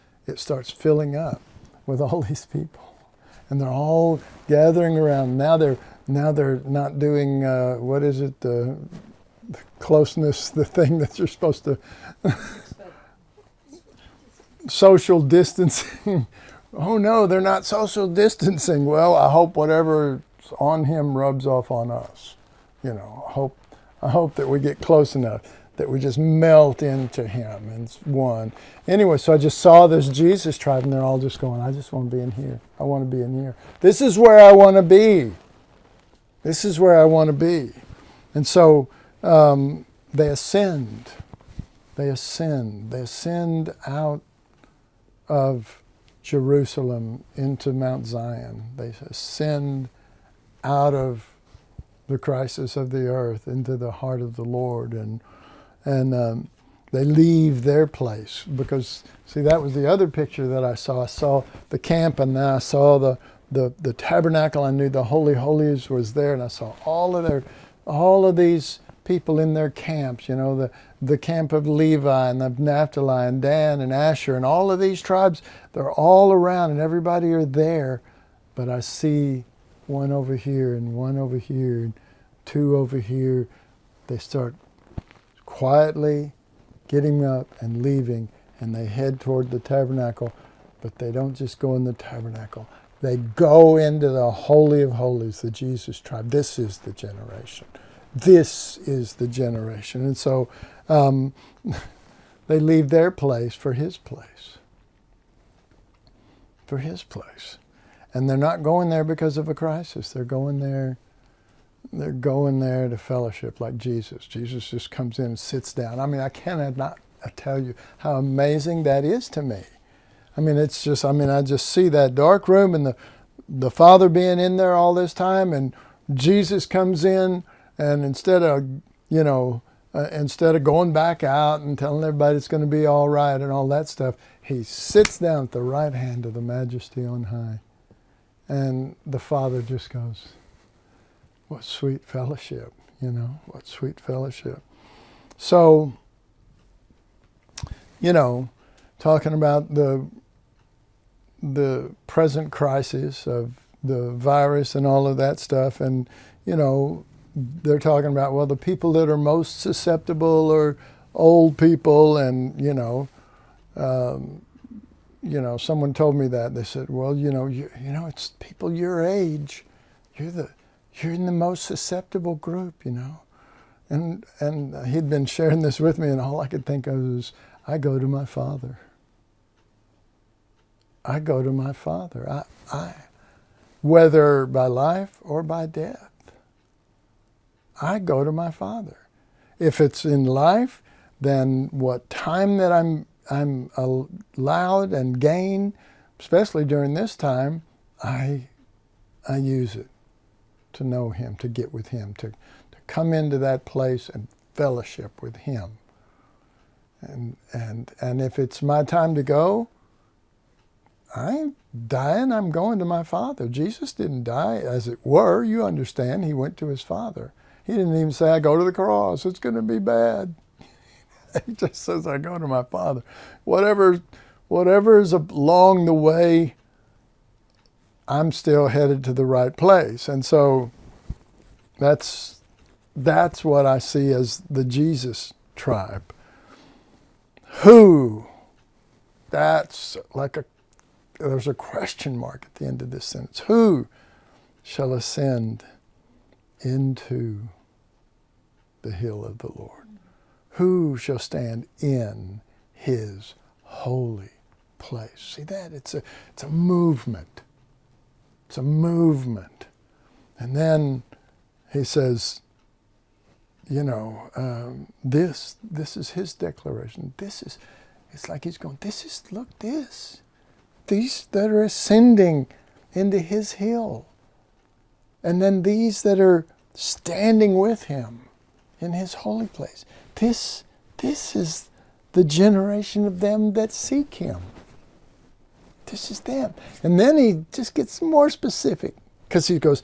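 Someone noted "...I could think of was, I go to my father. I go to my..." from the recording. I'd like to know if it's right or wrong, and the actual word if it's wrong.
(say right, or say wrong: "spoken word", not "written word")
right.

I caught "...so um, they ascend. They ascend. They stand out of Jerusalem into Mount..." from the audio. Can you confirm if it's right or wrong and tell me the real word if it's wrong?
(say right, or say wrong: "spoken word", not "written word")
wrong: "ascend", not "stand".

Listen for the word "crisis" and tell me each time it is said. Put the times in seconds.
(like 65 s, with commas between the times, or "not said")
52 s, 109 s, 152 s.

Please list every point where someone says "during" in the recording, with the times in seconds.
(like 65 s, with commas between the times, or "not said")
196 s.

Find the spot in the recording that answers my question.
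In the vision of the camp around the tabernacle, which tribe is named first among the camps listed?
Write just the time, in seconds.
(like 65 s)
71 s.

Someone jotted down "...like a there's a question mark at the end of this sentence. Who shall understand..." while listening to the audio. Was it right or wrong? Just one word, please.
wrong.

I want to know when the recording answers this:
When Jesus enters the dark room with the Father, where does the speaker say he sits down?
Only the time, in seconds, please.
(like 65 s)
135 s.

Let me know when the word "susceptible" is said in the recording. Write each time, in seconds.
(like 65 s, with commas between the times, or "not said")
159 s, 171 s.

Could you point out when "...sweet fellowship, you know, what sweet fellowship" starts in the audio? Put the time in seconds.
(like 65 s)
141 s.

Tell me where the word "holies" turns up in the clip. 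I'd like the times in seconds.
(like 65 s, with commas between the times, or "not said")
65 s, 94 s.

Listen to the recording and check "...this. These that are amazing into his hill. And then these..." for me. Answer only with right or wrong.
wrong.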